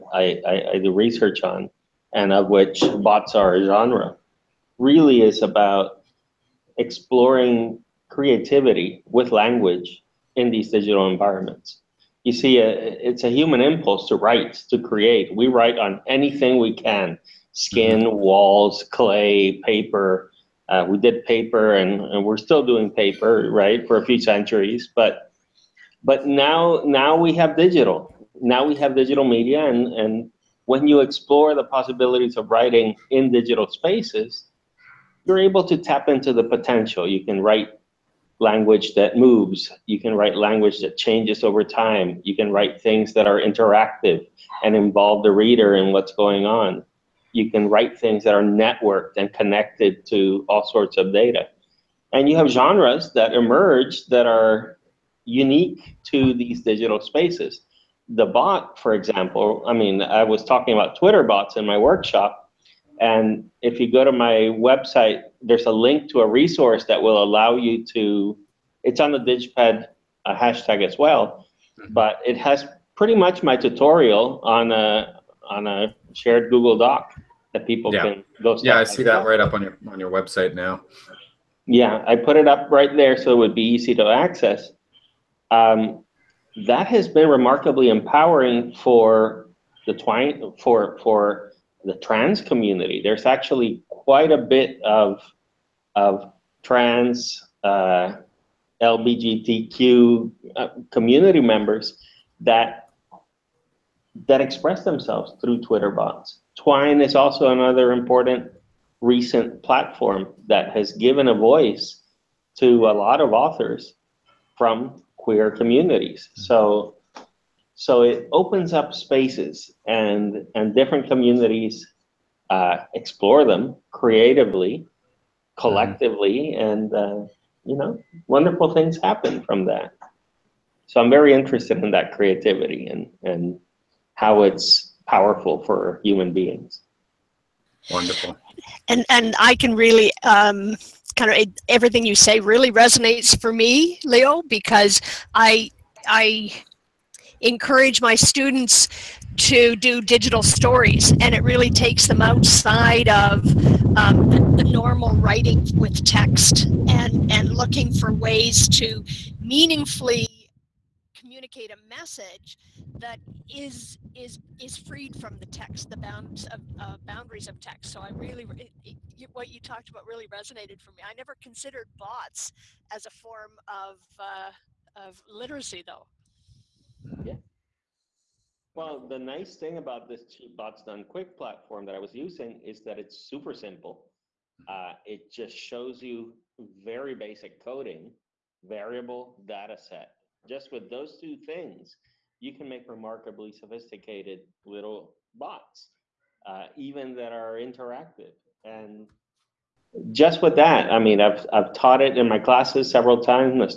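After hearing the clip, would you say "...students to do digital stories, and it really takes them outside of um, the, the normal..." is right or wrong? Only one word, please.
right.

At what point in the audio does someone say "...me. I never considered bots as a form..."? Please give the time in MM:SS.
02:50.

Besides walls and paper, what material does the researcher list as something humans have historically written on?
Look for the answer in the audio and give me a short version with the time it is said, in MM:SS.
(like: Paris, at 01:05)
Clay, at 00:18.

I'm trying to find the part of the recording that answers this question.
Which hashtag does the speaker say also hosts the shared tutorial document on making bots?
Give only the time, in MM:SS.
01:09.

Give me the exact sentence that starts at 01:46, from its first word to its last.
Twine is also another important recent platform that has given a voice to a lot of authors from queer communities.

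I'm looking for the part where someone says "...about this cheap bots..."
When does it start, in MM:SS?
02:59.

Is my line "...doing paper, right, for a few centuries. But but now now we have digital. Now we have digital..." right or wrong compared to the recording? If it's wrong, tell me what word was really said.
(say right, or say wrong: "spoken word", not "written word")
right.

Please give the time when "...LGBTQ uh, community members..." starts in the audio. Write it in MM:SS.
01:38.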